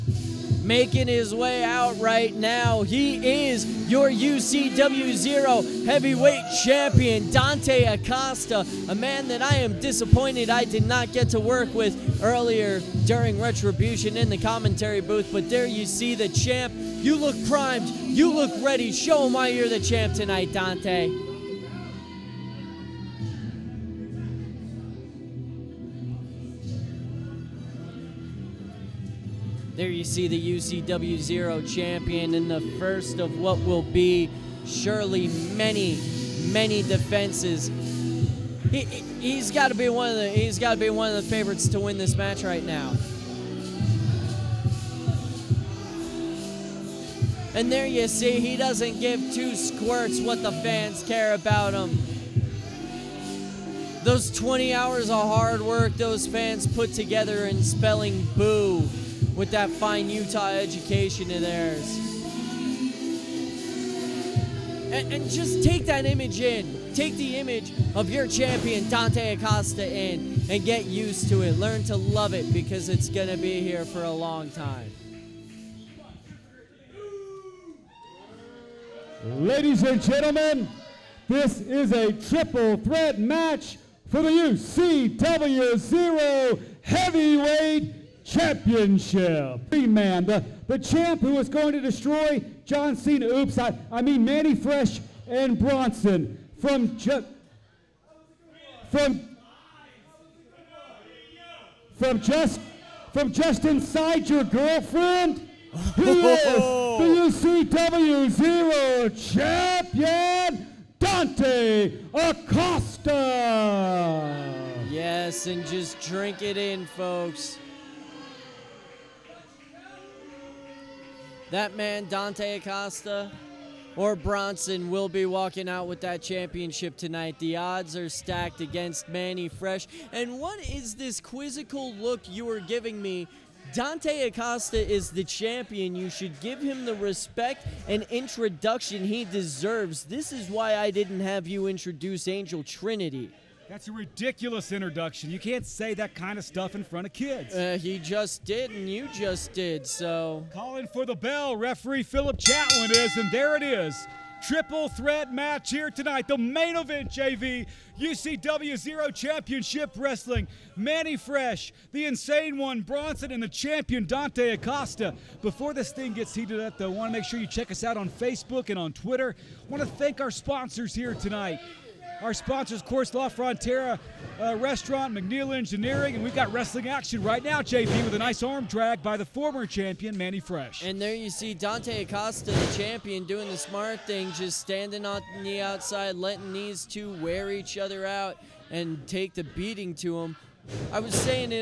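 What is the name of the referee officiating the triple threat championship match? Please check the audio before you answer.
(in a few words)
Philip Chatwin.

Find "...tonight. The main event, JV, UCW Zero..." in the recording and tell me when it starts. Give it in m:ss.
2:35.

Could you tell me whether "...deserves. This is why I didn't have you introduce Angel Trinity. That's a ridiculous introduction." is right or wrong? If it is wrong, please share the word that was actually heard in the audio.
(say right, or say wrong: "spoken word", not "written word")
right.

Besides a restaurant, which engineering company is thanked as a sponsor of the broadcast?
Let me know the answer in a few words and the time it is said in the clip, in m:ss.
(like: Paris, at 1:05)
McNeil Engineering, at 2:55.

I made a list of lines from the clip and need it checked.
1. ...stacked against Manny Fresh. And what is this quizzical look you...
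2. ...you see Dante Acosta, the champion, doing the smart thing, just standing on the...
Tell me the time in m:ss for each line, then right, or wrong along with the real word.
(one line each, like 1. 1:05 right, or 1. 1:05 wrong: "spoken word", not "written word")
1. 2:08 right
2. 3:01 right.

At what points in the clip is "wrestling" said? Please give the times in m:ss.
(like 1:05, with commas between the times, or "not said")
2:39, 2:56.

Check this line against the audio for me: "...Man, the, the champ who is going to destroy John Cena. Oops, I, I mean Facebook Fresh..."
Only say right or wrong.
wrong.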